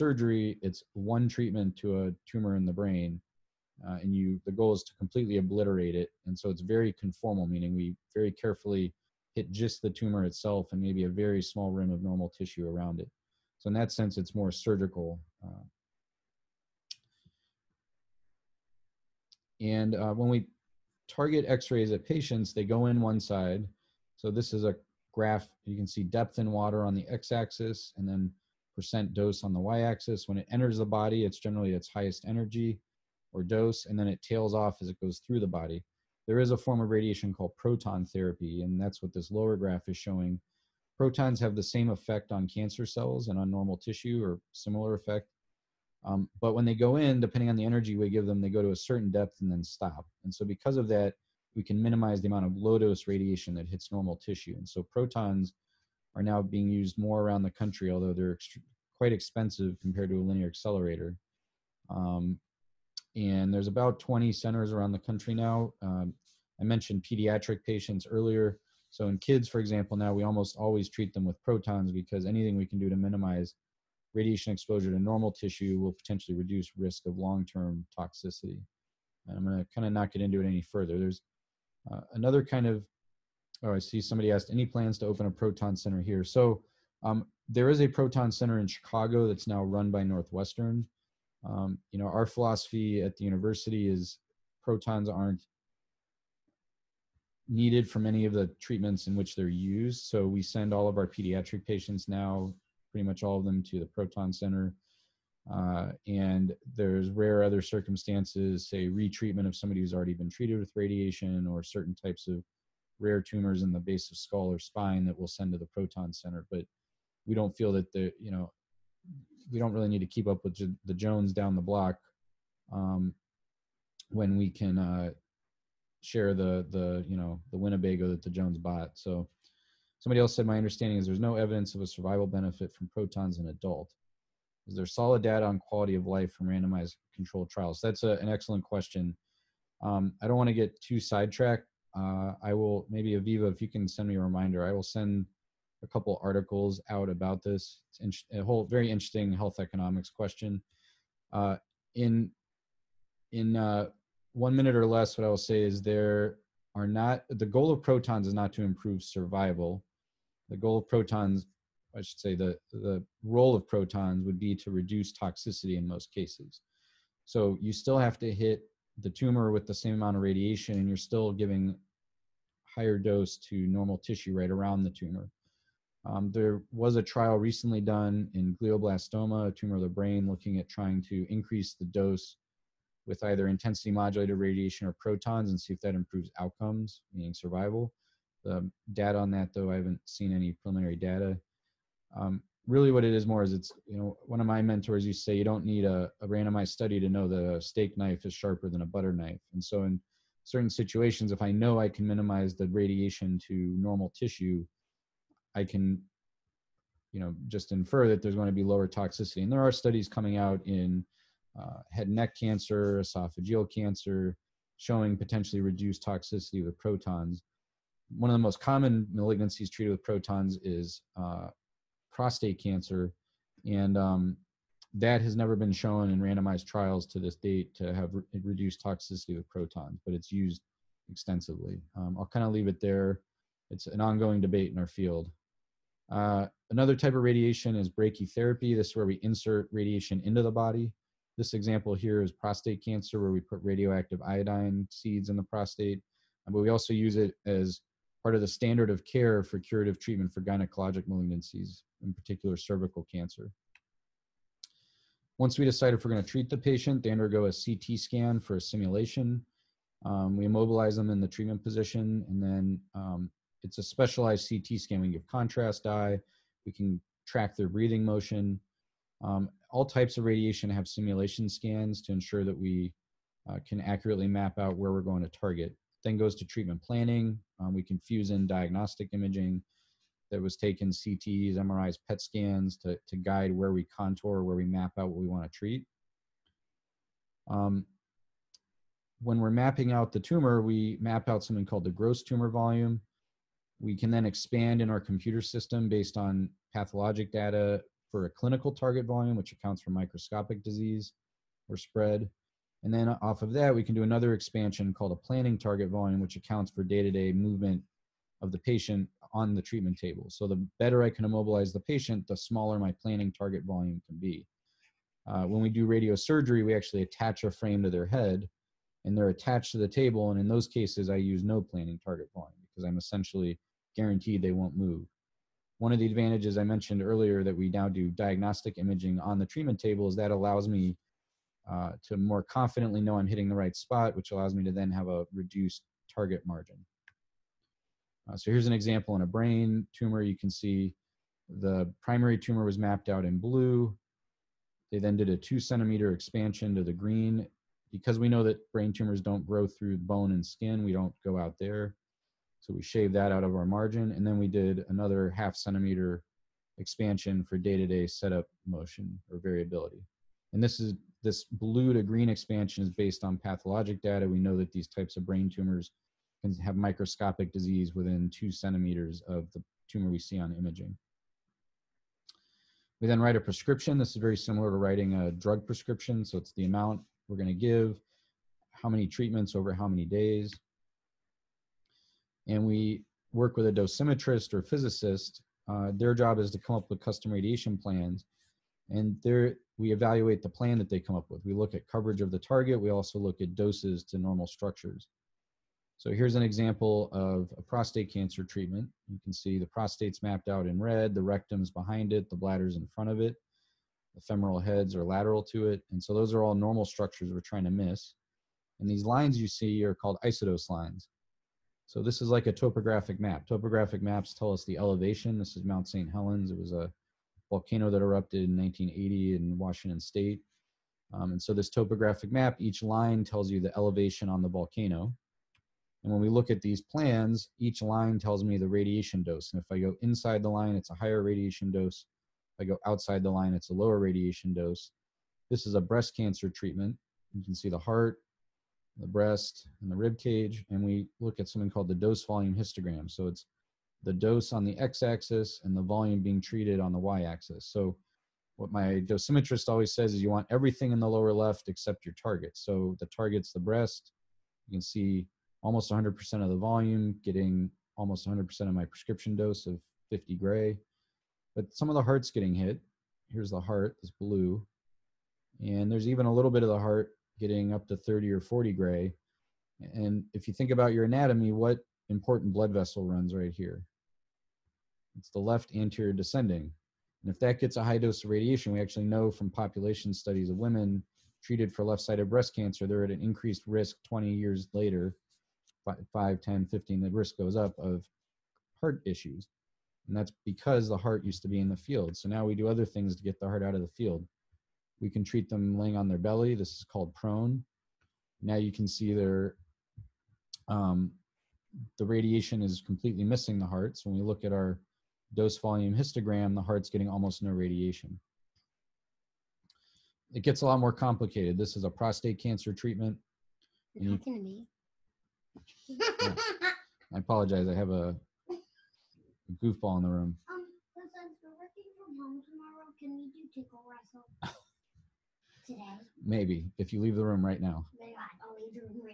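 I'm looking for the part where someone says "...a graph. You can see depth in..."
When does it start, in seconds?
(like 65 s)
24 s.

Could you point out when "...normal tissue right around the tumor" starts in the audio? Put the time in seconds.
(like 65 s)
173 s.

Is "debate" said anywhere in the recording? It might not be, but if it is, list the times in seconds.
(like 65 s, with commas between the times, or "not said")
234 s.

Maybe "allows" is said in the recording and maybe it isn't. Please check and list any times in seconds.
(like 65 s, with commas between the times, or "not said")
330 s, 334 s.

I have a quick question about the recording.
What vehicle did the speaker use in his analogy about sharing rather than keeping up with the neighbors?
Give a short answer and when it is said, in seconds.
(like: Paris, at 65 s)
Winnebago, at 127 s.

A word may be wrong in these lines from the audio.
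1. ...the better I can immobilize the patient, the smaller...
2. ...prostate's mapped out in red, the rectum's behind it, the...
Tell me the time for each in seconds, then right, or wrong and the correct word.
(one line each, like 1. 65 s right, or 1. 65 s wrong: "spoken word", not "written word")
1. 310 s right
2. 399 s right.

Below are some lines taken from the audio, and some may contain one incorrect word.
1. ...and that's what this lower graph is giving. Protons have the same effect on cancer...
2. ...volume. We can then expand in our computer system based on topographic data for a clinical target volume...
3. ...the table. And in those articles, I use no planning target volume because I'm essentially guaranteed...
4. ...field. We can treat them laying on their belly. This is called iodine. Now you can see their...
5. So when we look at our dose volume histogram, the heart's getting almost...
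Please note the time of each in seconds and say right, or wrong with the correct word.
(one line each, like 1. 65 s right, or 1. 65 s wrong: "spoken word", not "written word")
1. 38 s wrong: "showing", not "giving"
2. 292 s wrong: "pathologic", not "topographic"
3. 319 s wrong: "cases", not "articles"
4. 493 s wrong: "prone", not "iodine"
5. 503 s right.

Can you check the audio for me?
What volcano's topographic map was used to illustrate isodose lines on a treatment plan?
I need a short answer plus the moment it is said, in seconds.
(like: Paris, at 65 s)
Mount St. Helens, at 415 s.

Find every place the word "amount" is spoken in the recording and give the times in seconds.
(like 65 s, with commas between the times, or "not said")
52 s, 169 s, 376 s.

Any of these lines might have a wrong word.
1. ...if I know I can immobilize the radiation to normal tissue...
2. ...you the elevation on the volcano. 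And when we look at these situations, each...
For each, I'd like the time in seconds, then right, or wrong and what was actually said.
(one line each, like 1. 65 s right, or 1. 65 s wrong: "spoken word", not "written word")
1. 201 s wrong: "minimize", not "immobilize"
2. 423 s wrong: "plans", not "situations".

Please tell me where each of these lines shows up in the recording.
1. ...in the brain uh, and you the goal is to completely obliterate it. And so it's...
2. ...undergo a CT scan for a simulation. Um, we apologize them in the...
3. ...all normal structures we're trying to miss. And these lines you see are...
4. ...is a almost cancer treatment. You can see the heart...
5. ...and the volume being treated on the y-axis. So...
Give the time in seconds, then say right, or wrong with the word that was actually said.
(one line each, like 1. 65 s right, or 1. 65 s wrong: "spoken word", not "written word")
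1. 2 s right
2. 257 s wrong: "immobilize", not "apologize"
3. 406 s right
4. 435 s wrong: "breast", not "almost"
5. 445 s right.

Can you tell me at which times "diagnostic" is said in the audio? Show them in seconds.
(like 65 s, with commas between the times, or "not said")
278 s, 328 s.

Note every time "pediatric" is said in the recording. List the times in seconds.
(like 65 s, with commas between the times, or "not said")
67 s, 101 s.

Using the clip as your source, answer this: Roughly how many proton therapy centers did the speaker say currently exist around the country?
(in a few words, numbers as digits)
20.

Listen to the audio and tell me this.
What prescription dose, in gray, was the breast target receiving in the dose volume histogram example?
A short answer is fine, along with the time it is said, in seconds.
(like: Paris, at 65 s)
50 gray, at 460 s.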